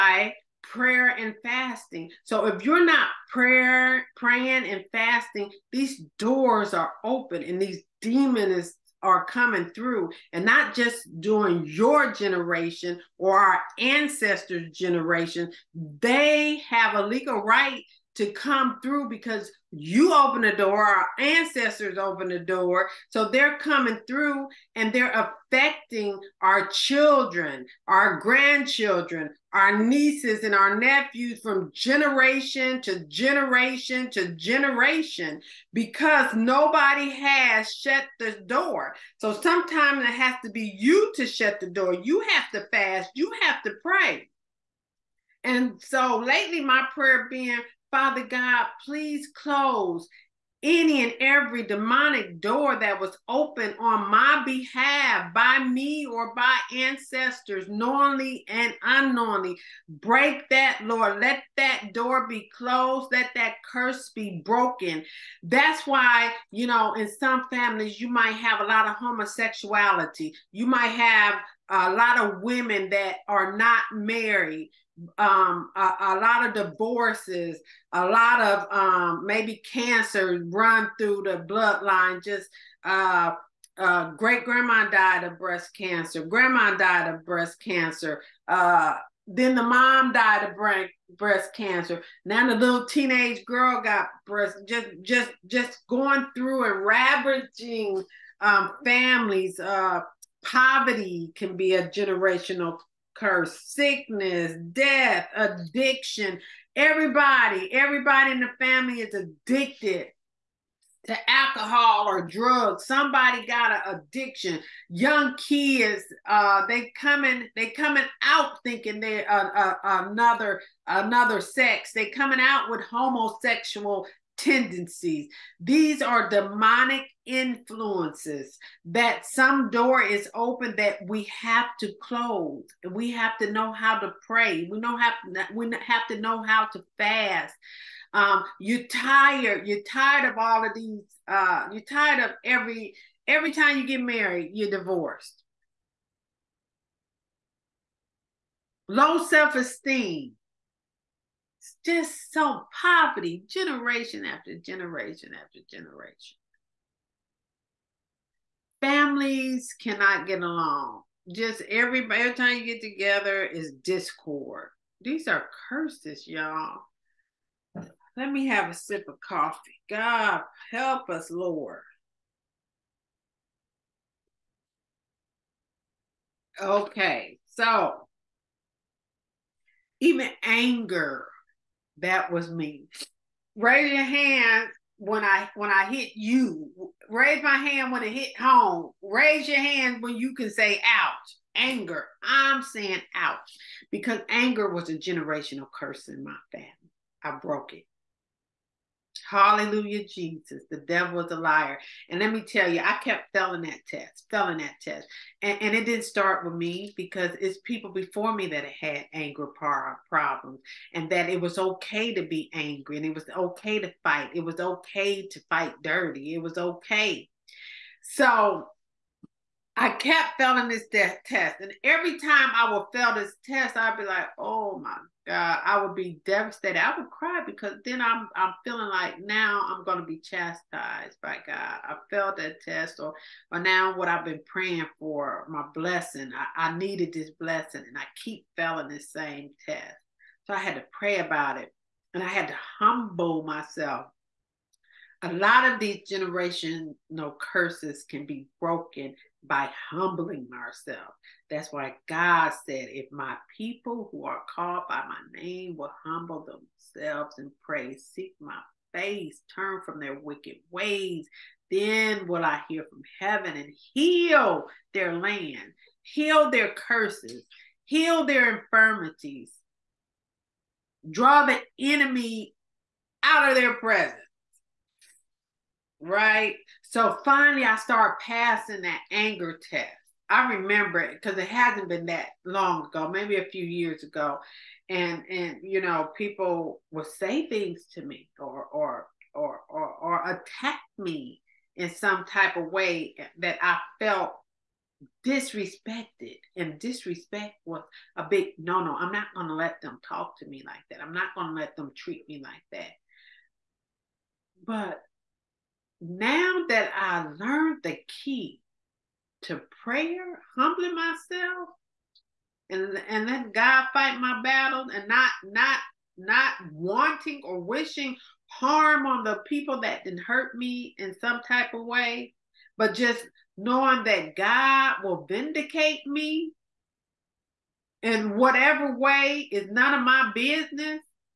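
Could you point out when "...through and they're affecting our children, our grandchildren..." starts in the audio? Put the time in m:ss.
0:24.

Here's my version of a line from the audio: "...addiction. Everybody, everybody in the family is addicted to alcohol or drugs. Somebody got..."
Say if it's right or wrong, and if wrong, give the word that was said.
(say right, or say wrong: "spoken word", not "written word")
right.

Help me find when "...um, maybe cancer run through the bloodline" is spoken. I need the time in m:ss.
1:18.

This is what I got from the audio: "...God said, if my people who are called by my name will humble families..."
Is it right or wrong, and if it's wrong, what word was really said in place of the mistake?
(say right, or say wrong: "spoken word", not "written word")
wrong: "themselves", not "families".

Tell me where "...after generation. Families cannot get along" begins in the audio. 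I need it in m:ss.
2:35.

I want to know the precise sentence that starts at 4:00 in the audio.
So I had to pray about it, and I had to humble myself.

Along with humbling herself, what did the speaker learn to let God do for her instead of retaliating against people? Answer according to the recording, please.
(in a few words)
fight my battles.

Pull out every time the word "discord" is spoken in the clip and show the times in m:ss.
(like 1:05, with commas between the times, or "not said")
2:43.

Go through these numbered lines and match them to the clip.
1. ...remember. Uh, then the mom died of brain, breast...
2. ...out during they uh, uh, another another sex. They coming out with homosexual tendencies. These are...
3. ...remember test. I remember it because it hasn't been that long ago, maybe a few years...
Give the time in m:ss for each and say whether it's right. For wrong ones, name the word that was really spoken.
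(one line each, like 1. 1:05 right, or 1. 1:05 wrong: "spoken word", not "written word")
1. 1:27 wrong: "cancer", not "remember"
2. 1:58 wrong: "thinking", not "during"
3. 4:39 wrong: "anger", not "remember".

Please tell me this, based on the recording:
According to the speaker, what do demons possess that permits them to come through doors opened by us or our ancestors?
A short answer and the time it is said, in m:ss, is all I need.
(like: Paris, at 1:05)
a legal right, at 0:16.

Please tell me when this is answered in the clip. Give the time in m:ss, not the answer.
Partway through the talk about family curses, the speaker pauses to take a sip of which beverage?
2:49.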